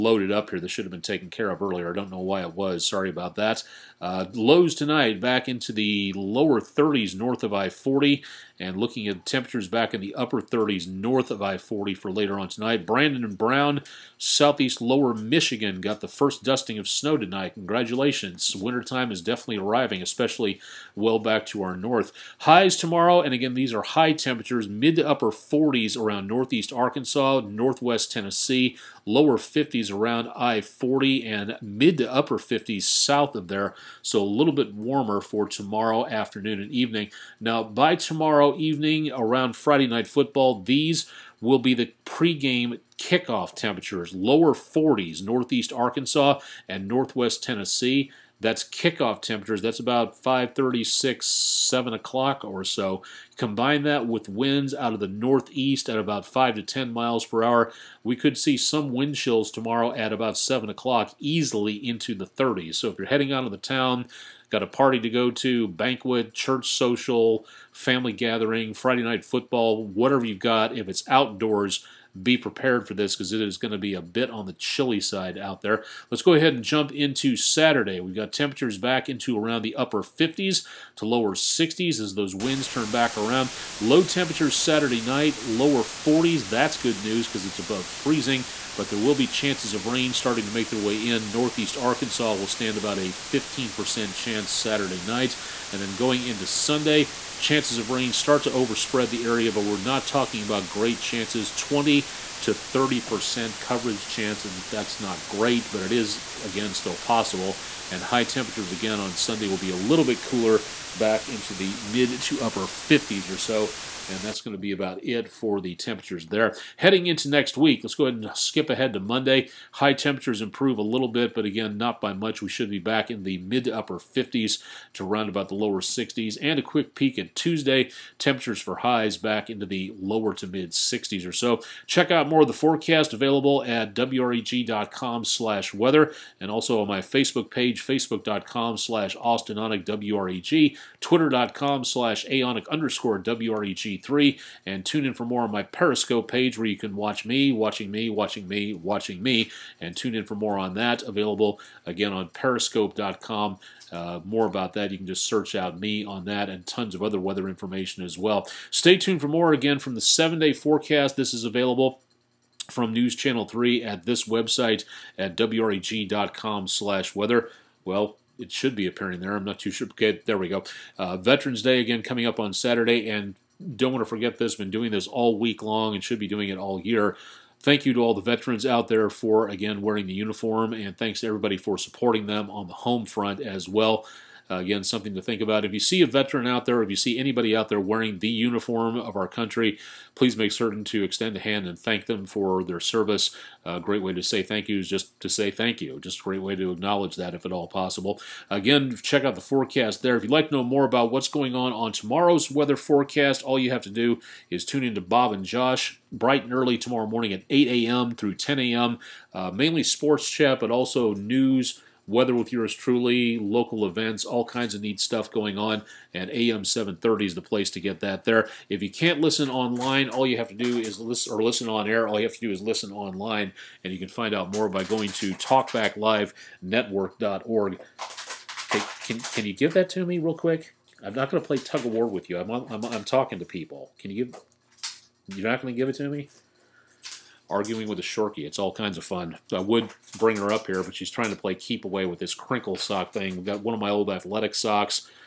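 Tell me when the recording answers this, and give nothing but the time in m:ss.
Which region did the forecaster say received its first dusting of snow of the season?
0:14.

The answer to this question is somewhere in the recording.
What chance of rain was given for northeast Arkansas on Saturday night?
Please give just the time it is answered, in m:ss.
1:33.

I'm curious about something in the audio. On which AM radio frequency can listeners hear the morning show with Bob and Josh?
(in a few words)
AM 730.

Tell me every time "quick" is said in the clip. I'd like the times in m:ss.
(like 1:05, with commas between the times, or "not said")
2:06, 3:50.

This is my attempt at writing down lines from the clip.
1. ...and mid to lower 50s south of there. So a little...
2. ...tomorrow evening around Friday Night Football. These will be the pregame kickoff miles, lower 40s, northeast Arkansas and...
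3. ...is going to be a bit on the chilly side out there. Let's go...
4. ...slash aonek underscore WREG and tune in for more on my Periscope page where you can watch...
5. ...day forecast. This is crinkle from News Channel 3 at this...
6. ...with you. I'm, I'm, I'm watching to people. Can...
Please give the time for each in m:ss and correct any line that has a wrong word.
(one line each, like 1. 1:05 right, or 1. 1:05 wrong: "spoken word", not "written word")
1. 0:31 wrong: "upper", not "lower"
2. 0:38 wrong: "temperatures", not "miles"
3. 1:13 right
4. 2:21 right
5. 2:40 wrong: "available", not "crinkle"
6. 3:52 wrong: "talking", not "watching".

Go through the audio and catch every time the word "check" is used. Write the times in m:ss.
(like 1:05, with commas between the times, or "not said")
2:11, 3:19.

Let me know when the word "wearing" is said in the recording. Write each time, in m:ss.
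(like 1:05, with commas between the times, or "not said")
2:59, 3:07.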